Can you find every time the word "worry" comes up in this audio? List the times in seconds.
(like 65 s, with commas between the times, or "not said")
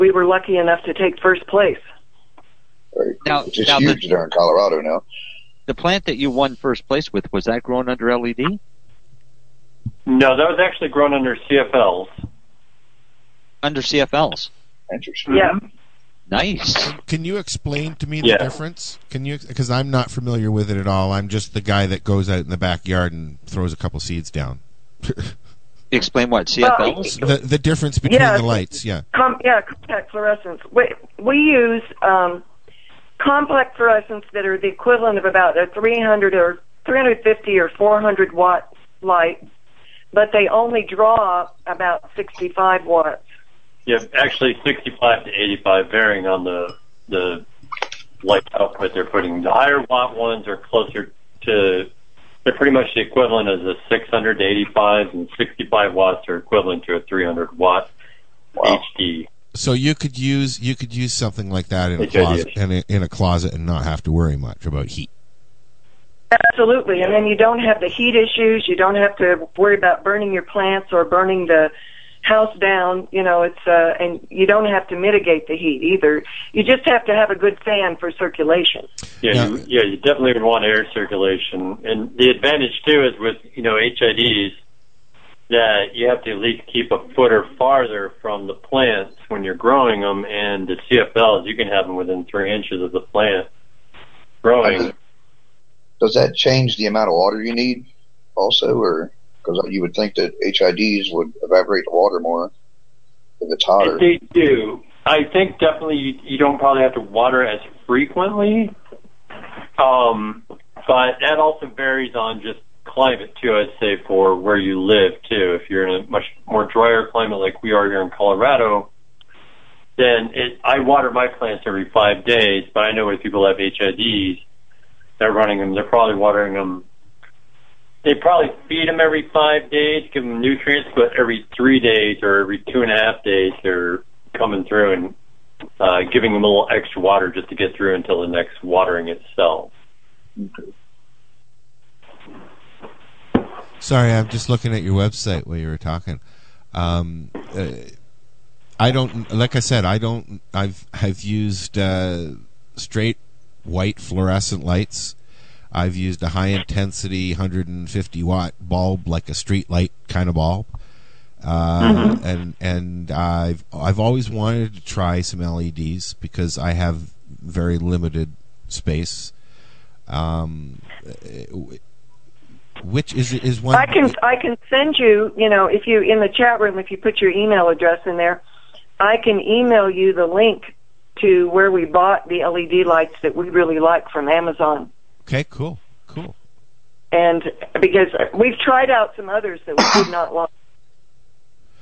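64 s, 69 s.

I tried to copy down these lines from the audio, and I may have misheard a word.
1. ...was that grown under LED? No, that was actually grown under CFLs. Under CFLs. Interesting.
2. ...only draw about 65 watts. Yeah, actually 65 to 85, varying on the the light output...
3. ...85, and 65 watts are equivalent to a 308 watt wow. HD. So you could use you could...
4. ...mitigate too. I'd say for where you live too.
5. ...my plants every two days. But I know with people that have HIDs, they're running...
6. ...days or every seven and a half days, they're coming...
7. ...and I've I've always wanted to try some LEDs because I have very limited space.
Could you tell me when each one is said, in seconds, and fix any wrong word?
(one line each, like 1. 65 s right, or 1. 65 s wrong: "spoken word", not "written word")
1. 7 s right
2. 40 s right
3. 54 s wrong: "300", not "308"
4. 112 s wrong: "climate", not "mitigate"
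5. 121 s wrong: "five", not "two"
6. 131 s wrong: "two", not "seven"
7. 162 s right.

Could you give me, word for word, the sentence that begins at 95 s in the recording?
Does that change the amount of water you need, also, or?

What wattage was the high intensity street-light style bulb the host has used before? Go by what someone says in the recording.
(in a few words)
150 watt.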